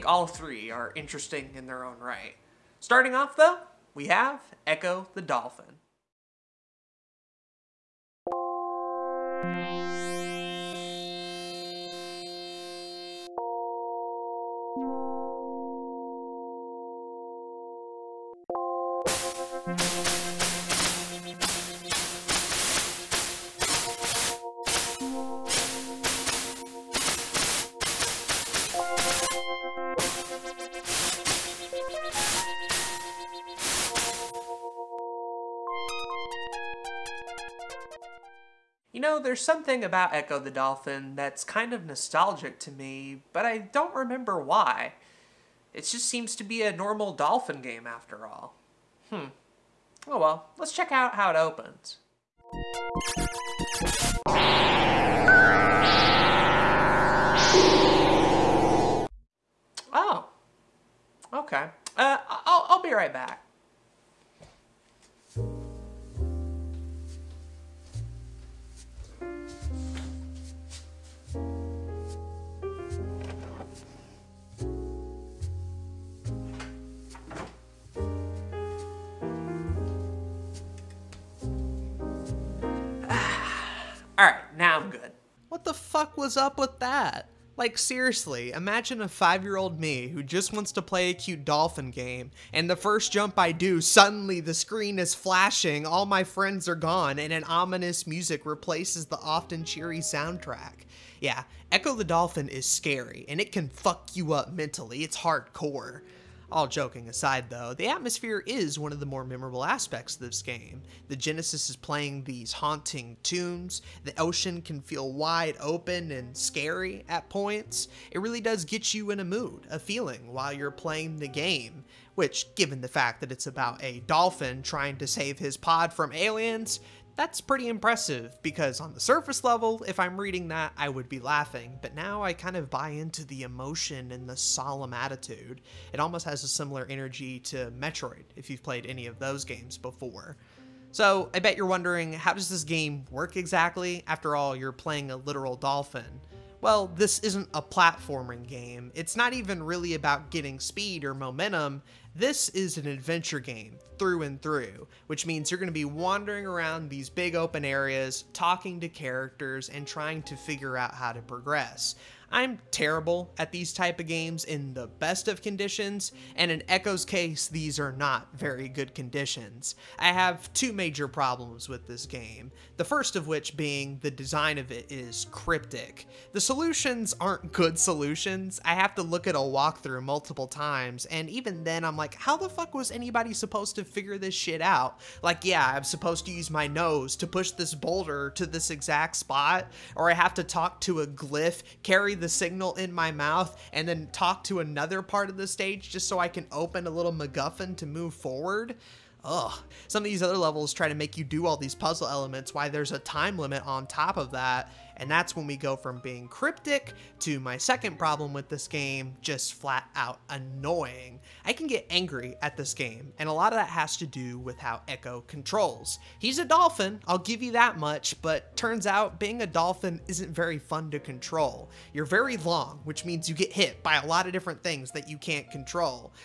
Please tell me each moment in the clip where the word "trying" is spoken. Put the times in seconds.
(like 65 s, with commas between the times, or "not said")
124 s, 159 s.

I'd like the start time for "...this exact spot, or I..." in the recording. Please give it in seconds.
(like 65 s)
188 s.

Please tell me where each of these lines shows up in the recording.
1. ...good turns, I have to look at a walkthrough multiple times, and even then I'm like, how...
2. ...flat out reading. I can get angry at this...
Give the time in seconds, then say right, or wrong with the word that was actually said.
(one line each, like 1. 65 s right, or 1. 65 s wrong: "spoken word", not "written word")
1. 177 s wrong: "solutions", not "turns"
2. 209 s wrong: "annoying", not "reading".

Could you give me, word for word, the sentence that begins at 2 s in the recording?
Starting off, though, we have Ecco the Dolphin.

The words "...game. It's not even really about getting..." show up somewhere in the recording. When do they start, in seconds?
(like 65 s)
148 s.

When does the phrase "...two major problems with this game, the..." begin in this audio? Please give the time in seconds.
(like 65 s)
170 s.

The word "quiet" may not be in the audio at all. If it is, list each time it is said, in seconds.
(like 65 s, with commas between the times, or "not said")
not said.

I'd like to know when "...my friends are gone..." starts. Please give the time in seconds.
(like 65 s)
96 s.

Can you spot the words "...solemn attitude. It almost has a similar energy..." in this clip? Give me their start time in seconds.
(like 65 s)
134 s.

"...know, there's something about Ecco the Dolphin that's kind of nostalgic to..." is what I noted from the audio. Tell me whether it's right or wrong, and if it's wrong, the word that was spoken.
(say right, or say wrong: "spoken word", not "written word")
right.